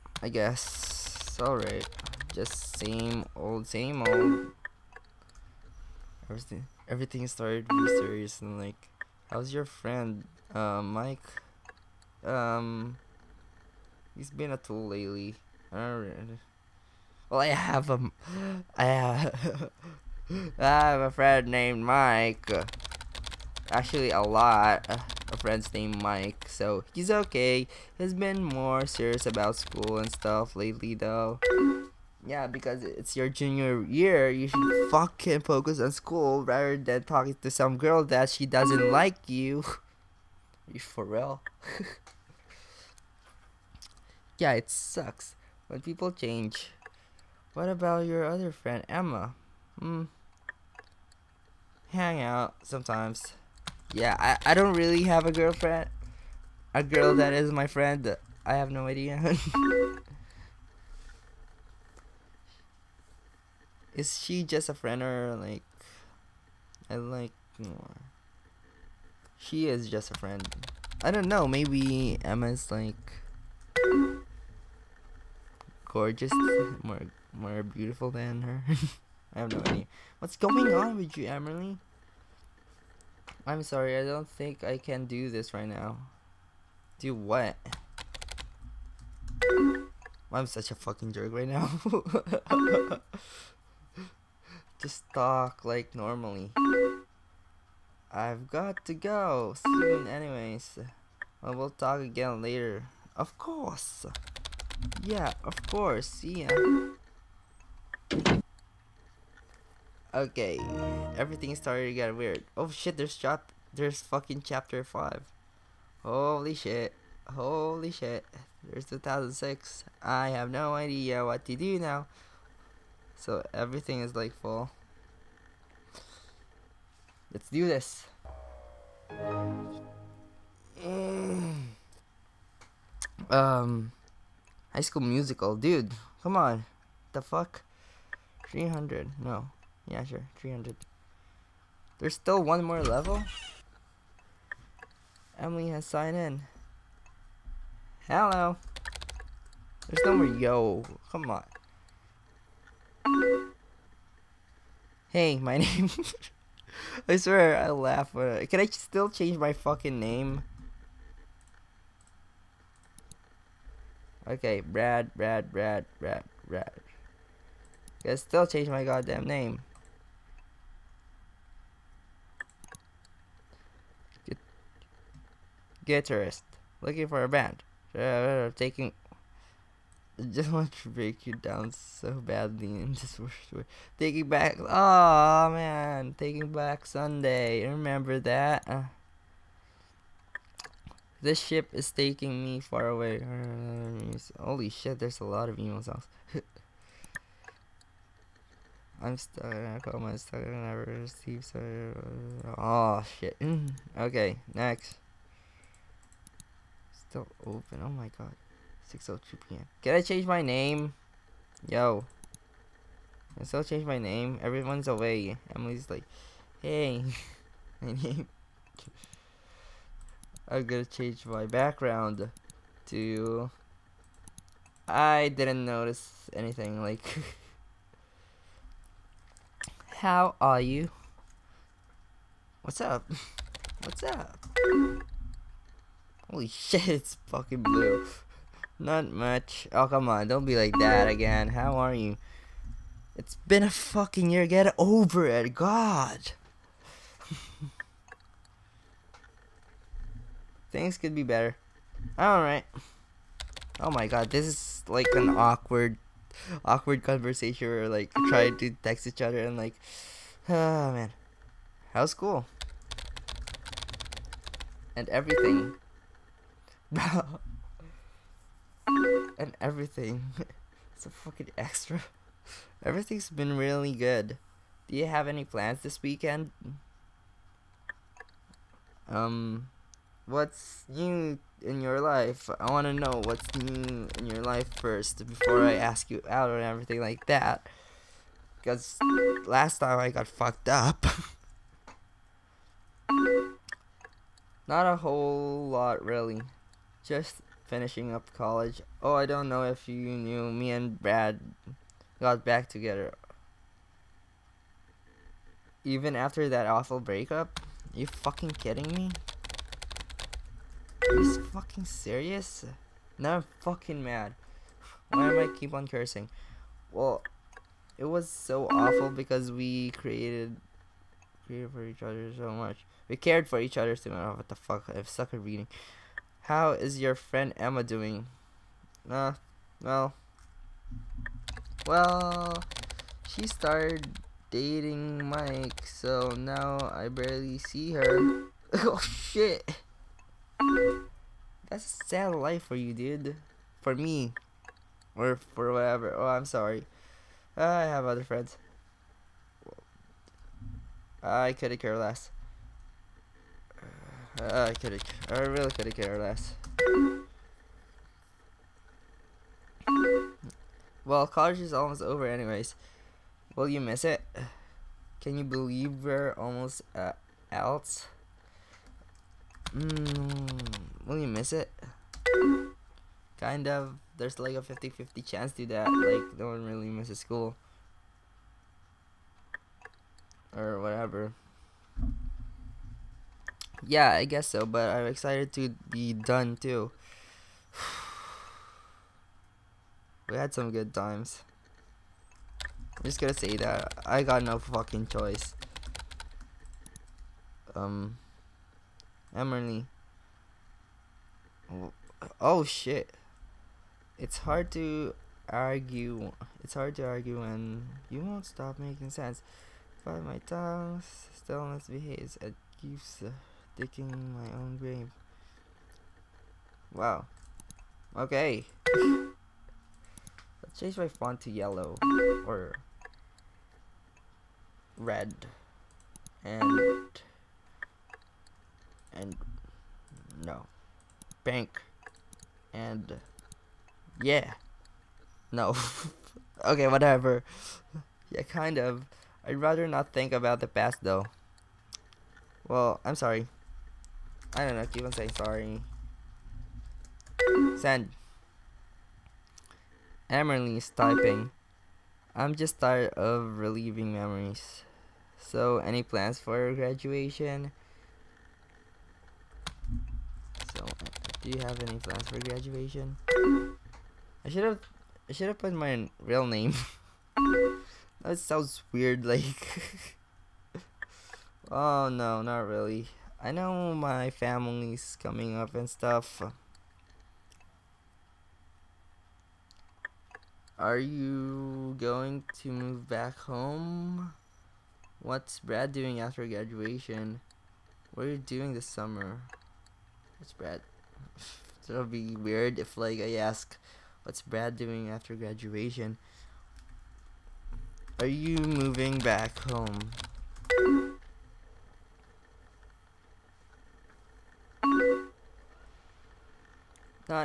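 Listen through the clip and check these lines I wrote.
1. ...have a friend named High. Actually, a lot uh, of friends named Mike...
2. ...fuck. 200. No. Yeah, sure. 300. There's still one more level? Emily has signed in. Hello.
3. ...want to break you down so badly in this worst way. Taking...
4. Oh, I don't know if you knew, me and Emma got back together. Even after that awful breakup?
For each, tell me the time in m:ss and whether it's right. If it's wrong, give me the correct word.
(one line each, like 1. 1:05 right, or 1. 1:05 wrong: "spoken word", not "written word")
1. 0:20 wrong: "Mike", not "High"
2. 2:17 wrong: "300", not "200"
3. 3:00 right
4. 4:59 wrong: "Brad", not "Emma".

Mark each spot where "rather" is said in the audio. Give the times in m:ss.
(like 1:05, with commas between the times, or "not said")
0:36, 7:19.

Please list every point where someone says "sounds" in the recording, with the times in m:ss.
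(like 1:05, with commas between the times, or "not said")
7:48.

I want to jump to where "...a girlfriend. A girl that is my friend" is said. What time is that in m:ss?
0:55.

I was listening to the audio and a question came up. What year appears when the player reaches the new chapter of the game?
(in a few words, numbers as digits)
2006.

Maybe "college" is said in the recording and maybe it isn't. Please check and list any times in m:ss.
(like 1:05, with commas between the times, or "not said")
4:58, 6:01.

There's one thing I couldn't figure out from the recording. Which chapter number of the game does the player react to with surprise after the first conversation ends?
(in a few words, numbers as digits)
5.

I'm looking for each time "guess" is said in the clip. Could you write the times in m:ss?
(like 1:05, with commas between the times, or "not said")
0:00, 6:24.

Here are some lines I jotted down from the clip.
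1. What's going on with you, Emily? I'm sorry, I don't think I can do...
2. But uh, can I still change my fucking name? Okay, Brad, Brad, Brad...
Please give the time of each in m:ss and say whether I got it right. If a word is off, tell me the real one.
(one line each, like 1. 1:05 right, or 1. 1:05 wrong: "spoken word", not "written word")
1. 1:20 right
2. 2:38 right.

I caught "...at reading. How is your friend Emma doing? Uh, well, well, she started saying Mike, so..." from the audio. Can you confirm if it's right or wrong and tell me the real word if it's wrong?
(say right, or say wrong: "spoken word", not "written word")
wrong: "dating", not "saying".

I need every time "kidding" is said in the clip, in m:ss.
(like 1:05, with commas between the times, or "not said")
5:08.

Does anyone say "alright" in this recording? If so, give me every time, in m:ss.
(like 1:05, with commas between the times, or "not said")
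0:01, 0:15, 4:12.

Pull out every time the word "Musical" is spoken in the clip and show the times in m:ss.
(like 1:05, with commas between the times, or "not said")
2:15.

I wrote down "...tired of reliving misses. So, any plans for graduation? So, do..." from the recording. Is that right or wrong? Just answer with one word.
wrong.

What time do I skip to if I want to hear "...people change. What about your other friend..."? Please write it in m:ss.
0:45.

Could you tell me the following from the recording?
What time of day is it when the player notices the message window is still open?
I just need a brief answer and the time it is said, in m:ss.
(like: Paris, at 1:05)
6:02 p.m., at 3:28.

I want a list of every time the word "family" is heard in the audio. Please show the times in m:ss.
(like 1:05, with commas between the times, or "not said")
7:54.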